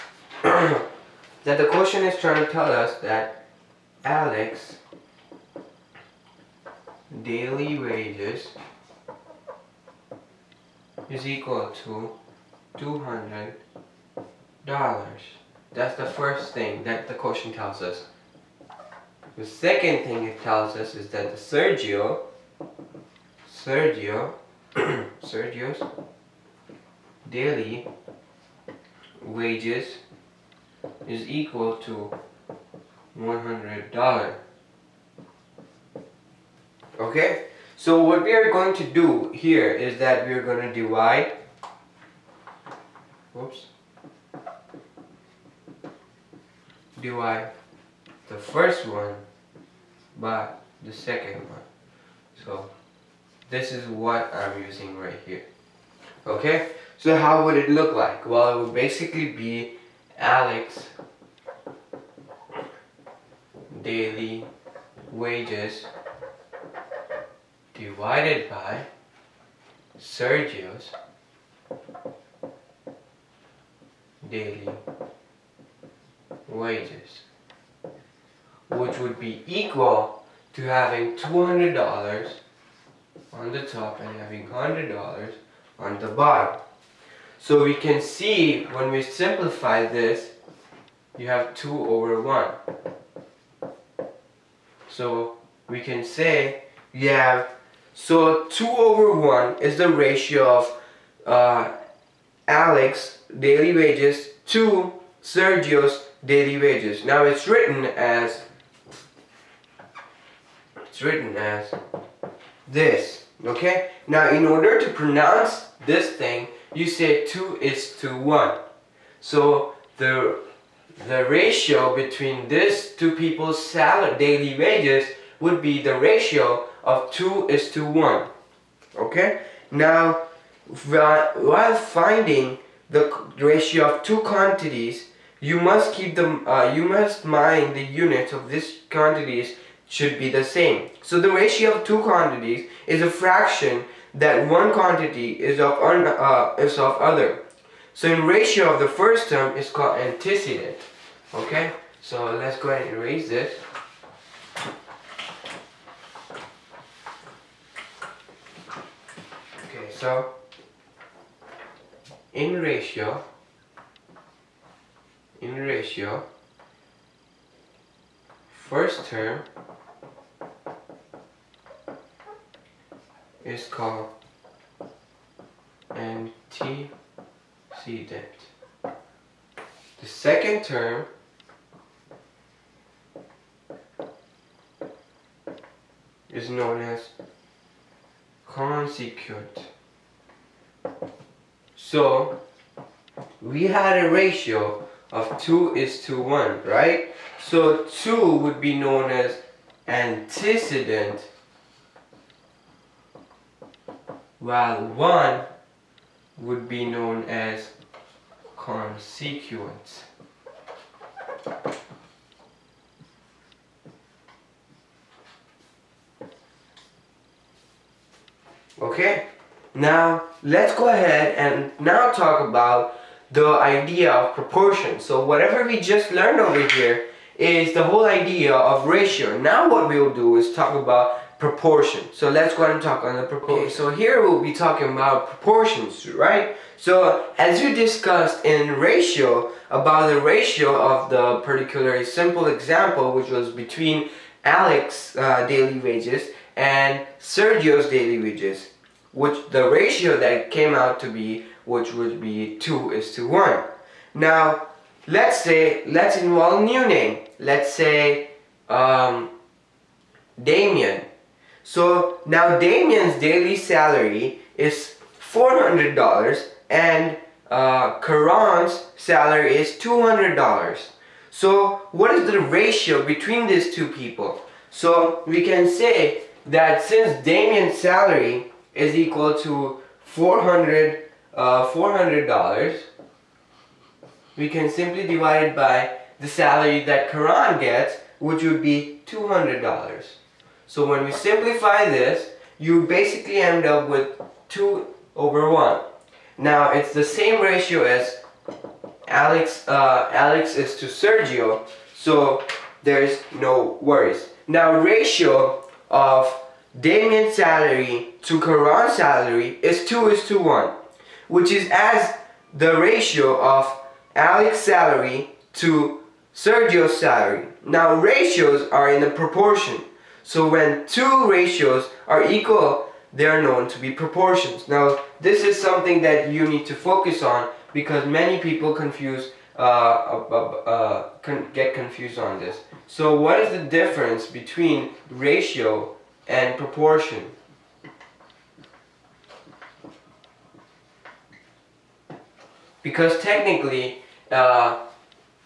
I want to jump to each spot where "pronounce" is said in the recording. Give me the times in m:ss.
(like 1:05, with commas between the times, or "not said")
1:54.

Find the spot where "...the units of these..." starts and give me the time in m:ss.
2:17.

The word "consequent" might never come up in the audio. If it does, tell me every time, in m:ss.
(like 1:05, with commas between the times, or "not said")
3:08, 3:28.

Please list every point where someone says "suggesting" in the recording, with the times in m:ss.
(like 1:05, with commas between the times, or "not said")
not said.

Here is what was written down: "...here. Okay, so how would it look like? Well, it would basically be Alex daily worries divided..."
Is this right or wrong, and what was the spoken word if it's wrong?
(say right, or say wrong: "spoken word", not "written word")
wrong: "wages", not "worries".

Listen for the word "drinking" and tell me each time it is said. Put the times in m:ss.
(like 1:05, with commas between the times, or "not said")
not said.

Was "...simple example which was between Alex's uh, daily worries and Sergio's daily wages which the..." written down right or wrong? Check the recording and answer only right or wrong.
wrong.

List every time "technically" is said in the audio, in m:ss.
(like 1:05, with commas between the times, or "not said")
5:43.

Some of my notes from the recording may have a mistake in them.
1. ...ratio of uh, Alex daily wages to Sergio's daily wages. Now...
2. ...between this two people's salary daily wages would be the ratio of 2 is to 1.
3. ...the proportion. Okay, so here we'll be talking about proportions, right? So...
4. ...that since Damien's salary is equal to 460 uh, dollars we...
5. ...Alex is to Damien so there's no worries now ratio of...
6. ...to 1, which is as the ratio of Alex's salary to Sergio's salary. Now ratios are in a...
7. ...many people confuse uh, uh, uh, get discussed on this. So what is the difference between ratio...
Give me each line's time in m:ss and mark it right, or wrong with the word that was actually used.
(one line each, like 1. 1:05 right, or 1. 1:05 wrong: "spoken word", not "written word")
1. 1:39 right
2. 2:01 right
3. 3:53 right
4. 4:36 wrong: "400", not "460"
5. 5:00 wrong: "Sergio", not "Damien"
6. 5:10 right
7. 5:28 wrong: "confused", not "discussed".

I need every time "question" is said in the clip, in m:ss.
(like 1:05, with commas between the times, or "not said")
0:01, 0:17.